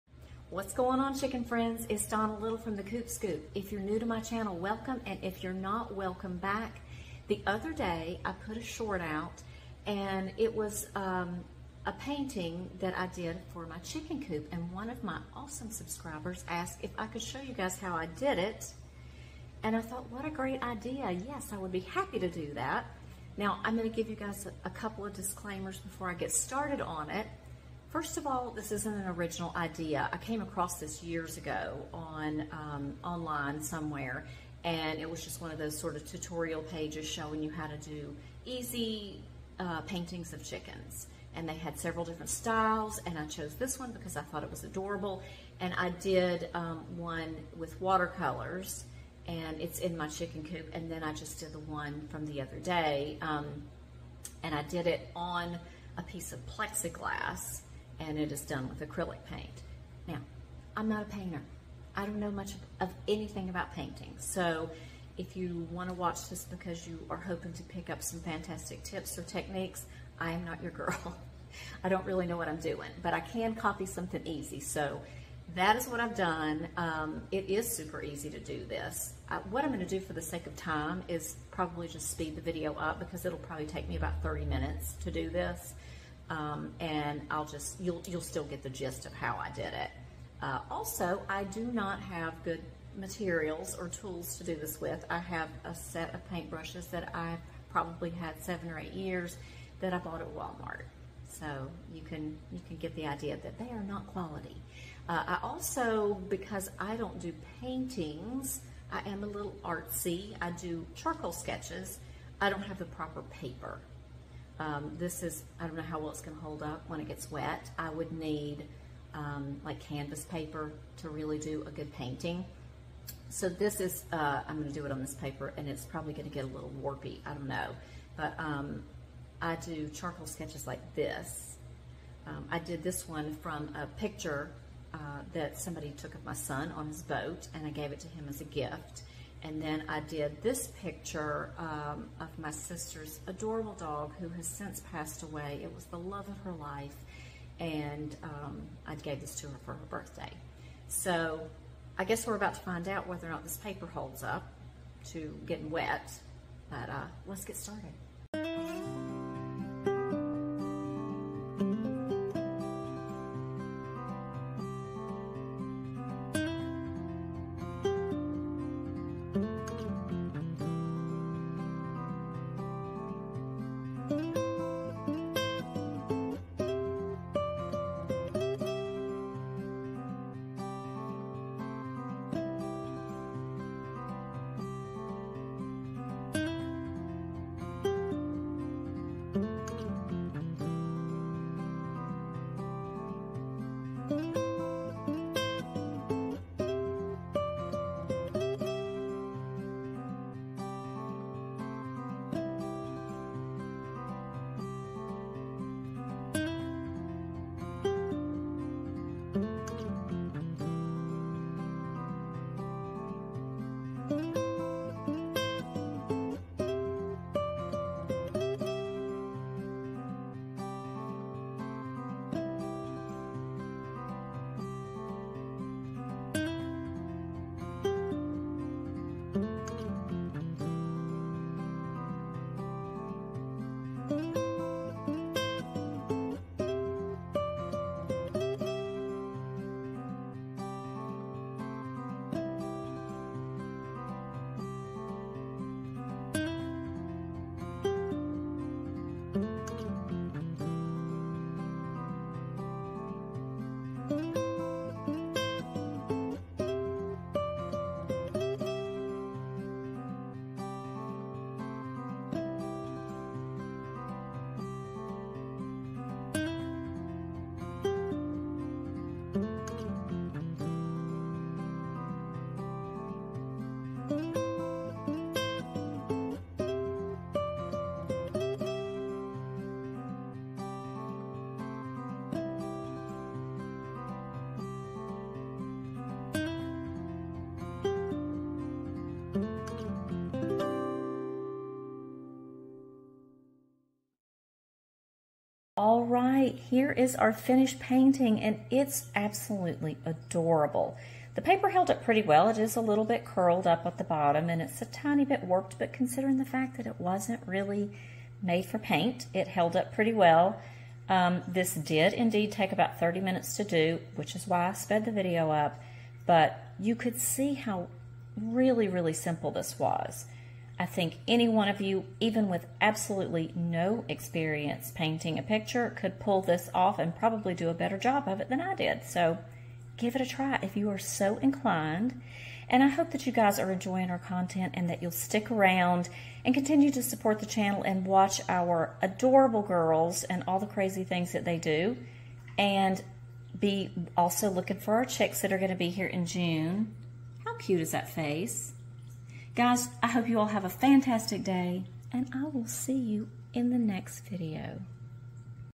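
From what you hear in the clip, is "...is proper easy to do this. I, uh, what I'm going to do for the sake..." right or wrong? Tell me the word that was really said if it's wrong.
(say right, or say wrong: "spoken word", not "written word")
wrong: "super", not "proper".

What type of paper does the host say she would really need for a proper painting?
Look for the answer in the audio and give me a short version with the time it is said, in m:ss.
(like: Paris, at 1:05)
canvas paper, at 1:59.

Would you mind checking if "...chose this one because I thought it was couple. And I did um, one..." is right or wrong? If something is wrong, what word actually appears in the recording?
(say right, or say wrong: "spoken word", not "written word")
wrong: "adorable", not "couple".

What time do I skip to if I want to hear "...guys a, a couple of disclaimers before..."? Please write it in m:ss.
0:24.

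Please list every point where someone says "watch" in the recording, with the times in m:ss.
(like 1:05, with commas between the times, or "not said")
1:05, 5:38.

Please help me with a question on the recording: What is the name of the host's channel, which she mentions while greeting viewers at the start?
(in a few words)
Coop Scoop.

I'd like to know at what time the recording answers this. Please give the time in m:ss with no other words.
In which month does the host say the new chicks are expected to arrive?
5:46.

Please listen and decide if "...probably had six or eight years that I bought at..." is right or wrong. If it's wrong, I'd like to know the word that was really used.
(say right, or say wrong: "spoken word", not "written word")
wrong: "seven", not "six".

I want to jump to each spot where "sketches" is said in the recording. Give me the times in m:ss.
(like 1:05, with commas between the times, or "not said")
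1:51, 2:10.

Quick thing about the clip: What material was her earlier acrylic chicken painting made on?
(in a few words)
plexiglass.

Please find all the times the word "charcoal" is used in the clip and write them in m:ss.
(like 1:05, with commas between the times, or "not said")
1:50, 2:09.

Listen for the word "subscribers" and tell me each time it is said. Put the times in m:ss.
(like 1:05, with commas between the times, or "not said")
0:15.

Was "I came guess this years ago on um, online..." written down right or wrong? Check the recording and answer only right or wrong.
wrong.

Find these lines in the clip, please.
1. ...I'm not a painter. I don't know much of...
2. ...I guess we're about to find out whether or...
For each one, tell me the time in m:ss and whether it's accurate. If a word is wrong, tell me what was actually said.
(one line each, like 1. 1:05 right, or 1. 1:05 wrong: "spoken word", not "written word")
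1. 1:00 right
2. 2:31 right.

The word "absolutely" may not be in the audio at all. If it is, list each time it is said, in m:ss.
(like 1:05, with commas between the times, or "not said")
4:59, 5:22.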